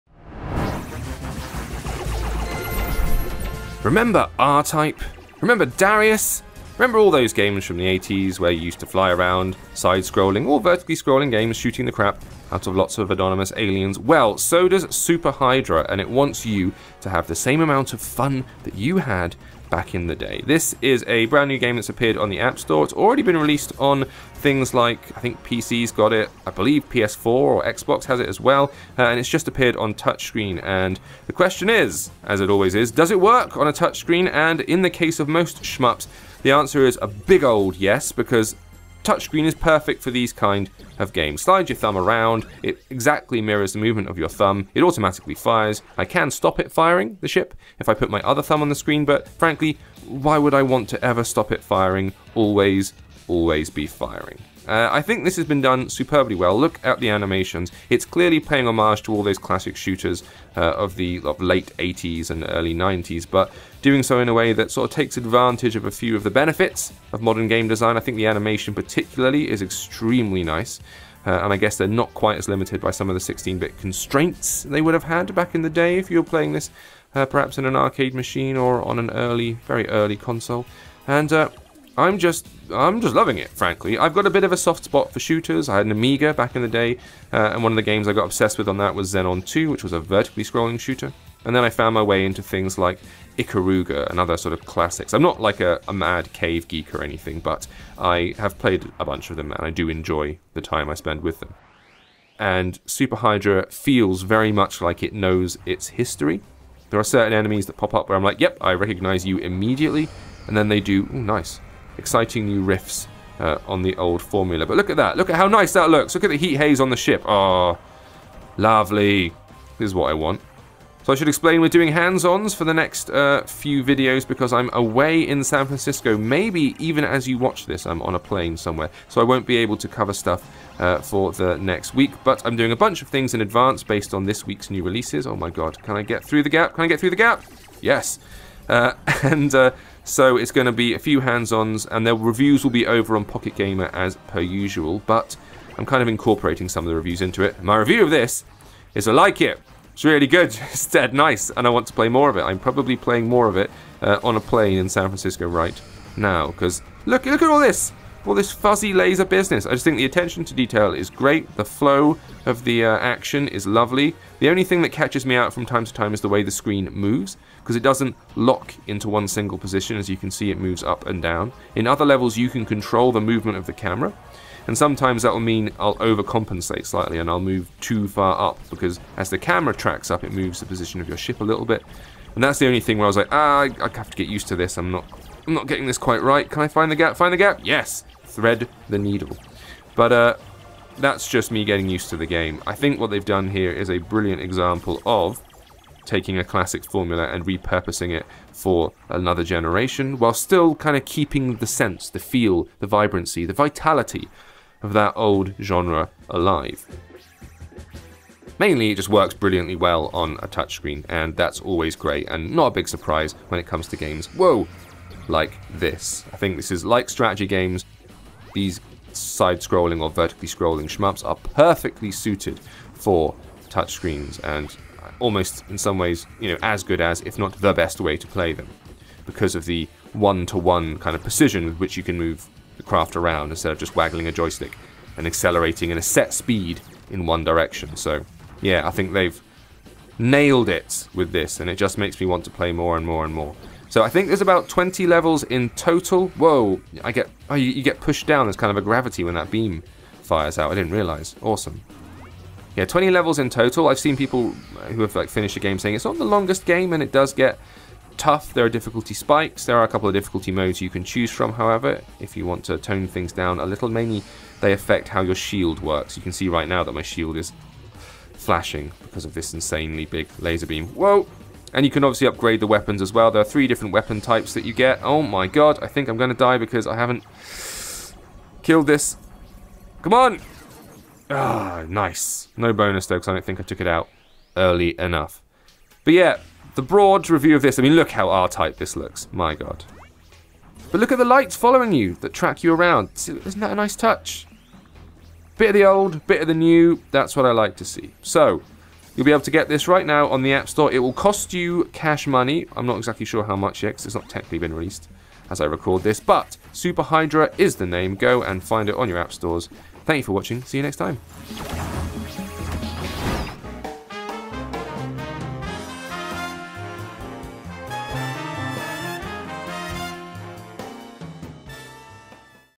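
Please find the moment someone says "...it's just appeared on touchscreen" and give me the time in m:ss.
0:29.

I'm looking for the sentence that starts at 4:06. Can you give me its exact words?
Whoa, I get, oh, you, you, get pushed down.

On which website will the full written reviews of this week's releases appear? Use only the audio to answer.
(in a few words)
Pocket Gamer.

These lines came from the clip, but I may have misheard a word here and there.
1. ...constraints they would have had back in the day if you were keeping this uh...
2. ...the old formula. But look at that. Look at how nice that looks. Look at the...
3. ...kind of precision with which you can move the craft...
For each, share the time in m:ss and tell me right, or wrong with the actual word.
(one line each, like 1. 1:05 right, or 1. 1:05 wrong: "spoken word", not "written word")
1. 1:13 wrong: "playing", not "keeping"
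2. 1:53 right
3. 3:50 right.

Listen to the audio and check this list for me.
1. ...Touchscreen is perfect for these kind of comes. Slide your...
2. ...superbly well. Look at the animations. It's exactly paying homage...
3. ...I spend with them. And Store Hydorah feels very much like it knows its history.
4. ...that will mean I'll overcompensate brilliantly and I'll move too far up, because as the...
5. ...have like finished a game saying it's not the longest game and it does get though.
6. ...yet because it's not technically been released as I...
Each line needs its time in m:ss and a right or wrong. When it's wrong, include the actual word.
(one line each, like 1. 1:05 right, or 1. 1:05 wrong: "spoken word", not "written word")
1. 0:39 wrong: "games", not "comes"
2. 0:55 wrong: "clearly", not "exactly"
3. 1:40 wrong: "Super", not "Store"
4. 2:55 wrong: "slightly", not "brilliantly"
5. 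4:15 wrong: "tough", not "though"
6. 5:03 right.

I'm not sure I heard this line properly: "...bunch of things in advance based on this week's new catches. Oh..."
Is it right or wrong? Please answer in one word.
wrong.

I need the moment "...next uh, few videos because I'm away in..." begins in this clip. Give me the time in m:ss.
2:02.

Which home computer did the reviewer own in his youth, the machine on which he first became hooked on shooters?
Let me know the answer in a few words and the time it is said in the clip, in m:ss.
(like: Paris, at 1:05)
Amiga, at 1:25.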